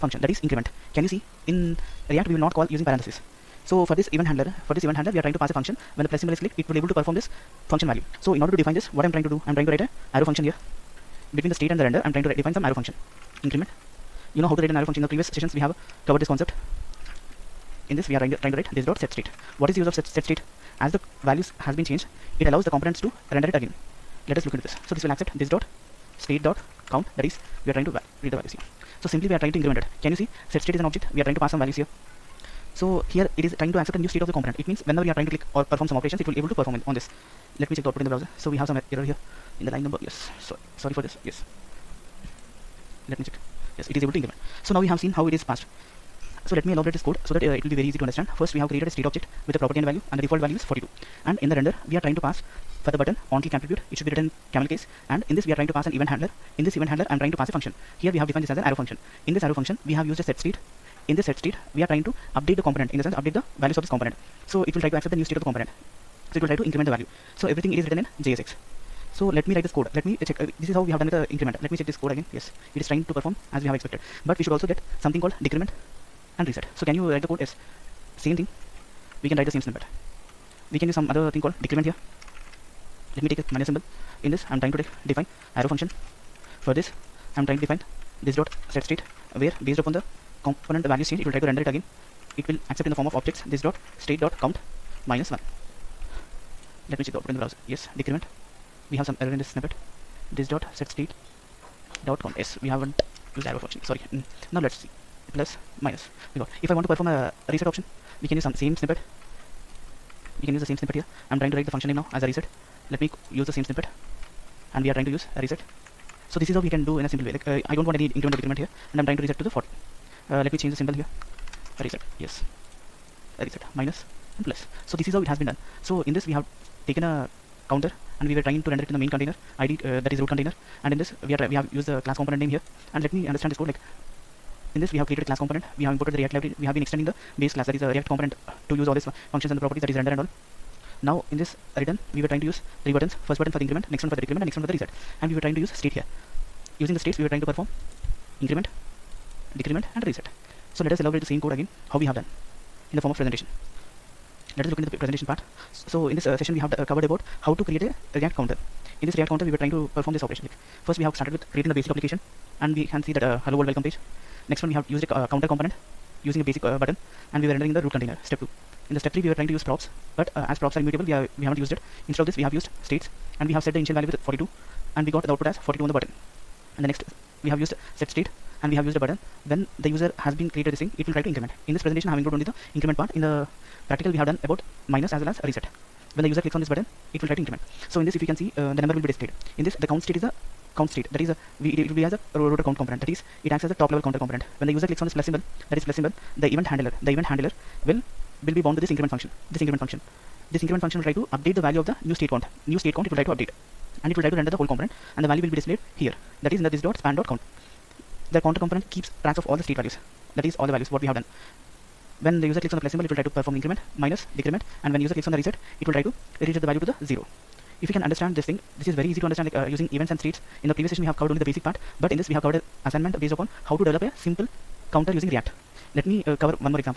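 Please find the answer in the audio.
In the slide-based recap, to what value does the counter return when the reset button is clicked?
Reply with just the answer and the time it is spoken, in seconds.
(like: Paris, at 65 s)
zero, at 217 s.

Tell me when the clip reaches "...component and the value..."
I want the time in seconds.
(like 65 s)
204 s.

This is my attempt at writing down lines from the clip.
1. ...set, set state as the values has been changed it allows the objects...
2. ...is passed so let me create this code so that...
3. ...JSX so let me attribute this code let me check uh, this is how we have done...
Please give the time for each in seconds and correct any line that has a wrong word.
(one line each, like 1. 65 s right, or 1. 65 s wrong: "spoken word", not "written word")
1. 19 s wrong: "components", not "objects"
2. 45 s wrong: "elaborate", not "create"
3. 68 s wrong: "write", not "attribute".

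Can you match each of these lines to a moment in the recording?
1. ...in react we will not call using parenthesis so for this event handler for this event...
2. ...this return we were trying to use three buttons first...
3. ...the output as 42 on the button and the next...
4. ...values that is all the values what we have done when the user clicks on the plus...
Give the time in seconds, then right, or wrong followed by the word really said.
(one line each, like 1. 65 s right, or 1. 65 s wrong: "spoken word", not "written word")
1. 1 s right
2. 141 s right
3. 175 s right
4. 209 s right.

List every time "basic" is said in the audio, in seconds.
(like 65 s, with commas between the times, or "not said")
161 s, 166 s, 221 s.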